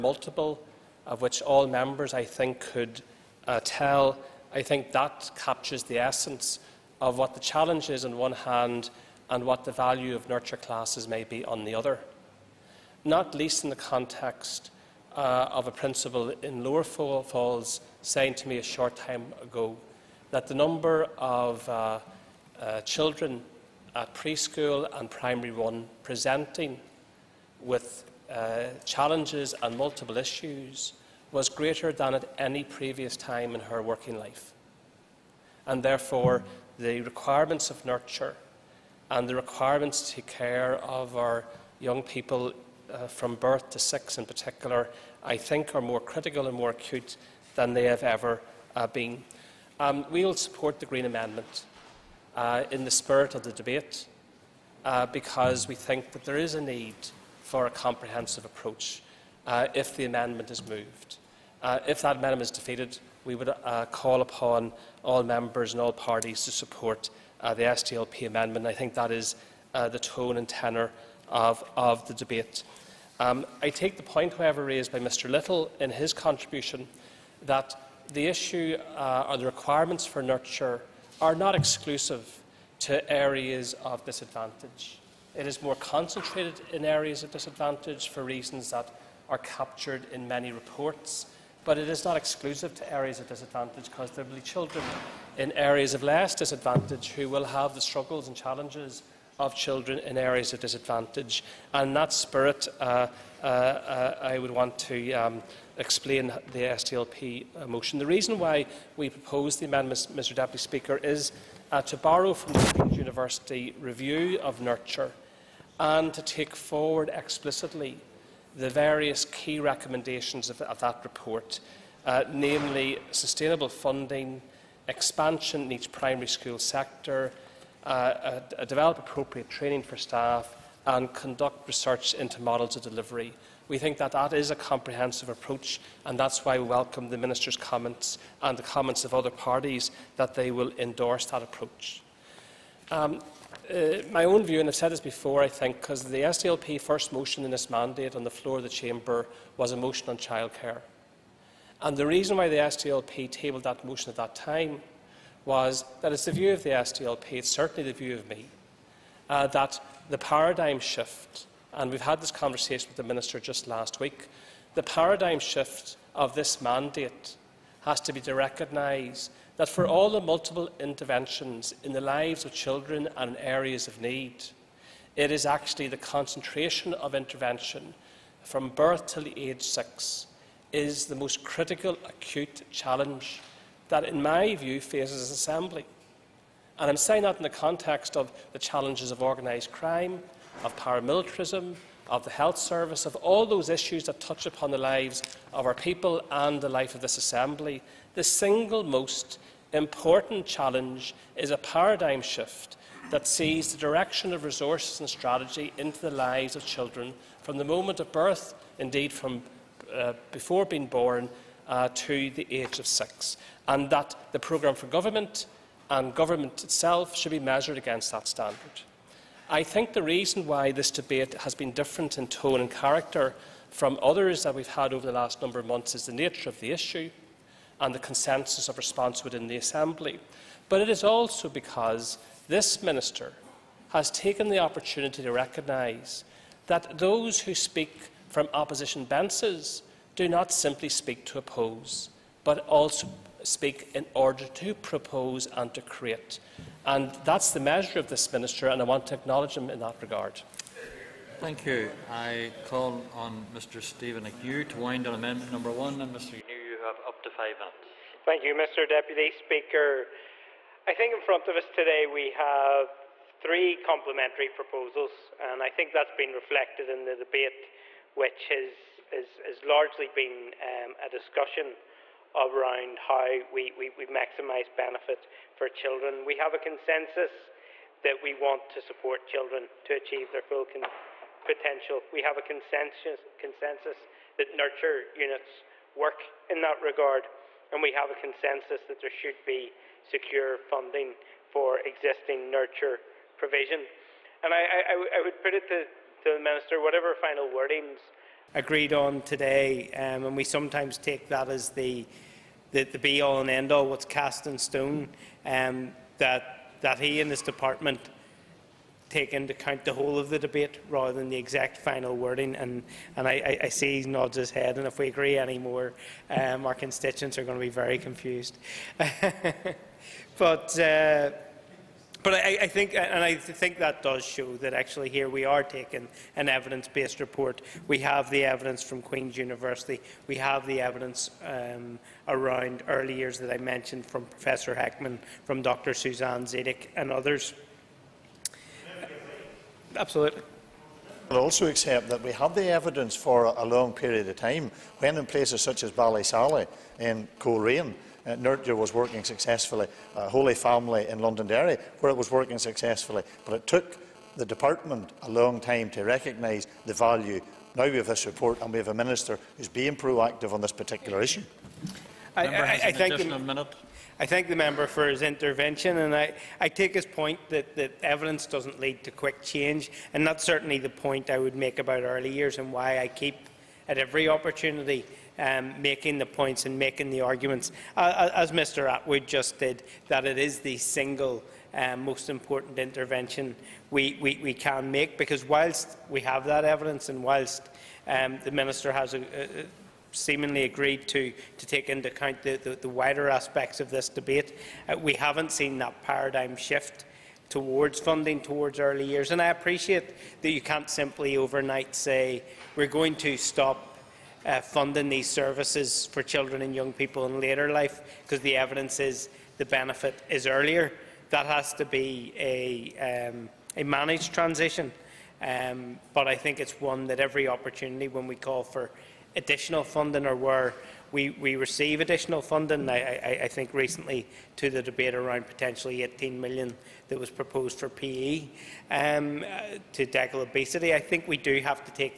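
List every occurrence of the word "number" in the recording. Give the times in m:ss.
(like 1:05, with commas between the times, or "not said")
0:20, 3:45, 4:15.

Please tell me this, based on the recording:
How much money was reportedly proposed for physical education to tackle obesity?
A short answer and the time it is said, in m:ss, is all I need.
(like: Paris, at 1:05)
18 million, at 7:06.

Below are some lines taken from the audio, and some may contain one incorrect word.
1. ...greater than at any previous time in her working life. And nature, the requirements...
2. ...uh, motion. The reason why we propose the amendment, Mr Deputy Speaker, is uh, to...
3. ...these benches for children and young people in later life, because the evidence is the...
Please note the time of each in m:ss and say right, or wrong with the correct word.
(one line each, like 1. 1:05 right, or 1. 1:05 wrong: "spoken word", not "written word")
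1. 0:31 wrong: "therefore", not "nature"
2. 1:47 right
3. 6:45 wrong: "services", not "benches".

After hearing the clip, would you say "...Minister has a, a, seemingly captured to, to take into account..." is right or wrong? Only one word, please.
wrong.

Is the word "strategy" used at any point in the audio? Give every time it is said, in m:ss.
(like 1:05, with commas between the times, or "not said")
3:25.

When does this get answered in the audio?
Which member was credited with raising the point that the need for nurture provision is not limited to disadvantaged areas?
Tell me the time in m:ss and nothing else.
1:14.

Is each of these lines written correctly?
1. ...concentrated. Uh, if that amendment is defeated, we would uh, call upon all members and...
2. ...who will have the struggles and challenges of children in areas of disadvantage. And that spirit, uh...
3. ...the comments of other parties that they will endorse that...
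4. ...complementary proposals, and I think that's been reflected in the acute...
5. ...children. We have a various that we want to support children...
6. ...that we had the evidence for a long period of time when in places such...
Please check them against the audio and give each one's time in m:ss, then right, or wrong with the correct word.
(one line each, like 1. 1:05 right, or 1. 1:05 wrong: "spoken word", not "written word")
1. 1:00 wrong: "moved", not "concentrated"
2. 1:37 right
3. 2:18 right
4. 4:23 wrong: "debate", not "acute"
5. 4:35 wrong: "consensus", not "various"
6. 5:42 right.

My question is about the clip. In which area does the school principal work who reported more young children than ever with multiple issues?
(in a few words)
Lower Falls.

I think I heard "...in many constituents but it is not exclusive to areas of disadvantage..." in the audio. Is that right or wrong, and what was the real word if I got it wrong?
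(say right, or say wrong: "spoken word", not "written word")
wrong: "reports", not "constituents".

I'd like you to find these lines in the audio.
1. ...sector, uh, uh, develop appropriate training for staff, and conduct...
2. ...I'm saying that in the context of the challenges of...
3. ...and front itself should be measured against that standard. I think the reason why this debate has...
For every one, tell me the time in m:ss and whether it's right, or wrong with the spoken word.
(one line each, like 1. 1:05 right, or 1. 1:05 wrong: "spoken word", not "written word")
1. 2:06 right
2. 3:06 right
3. 3:35 wrong: "government", not "front".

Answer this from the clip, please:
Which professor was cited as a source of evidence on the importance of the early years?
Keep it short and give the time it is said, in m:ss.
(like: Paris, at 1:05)
Professor Heckman, at 5:34.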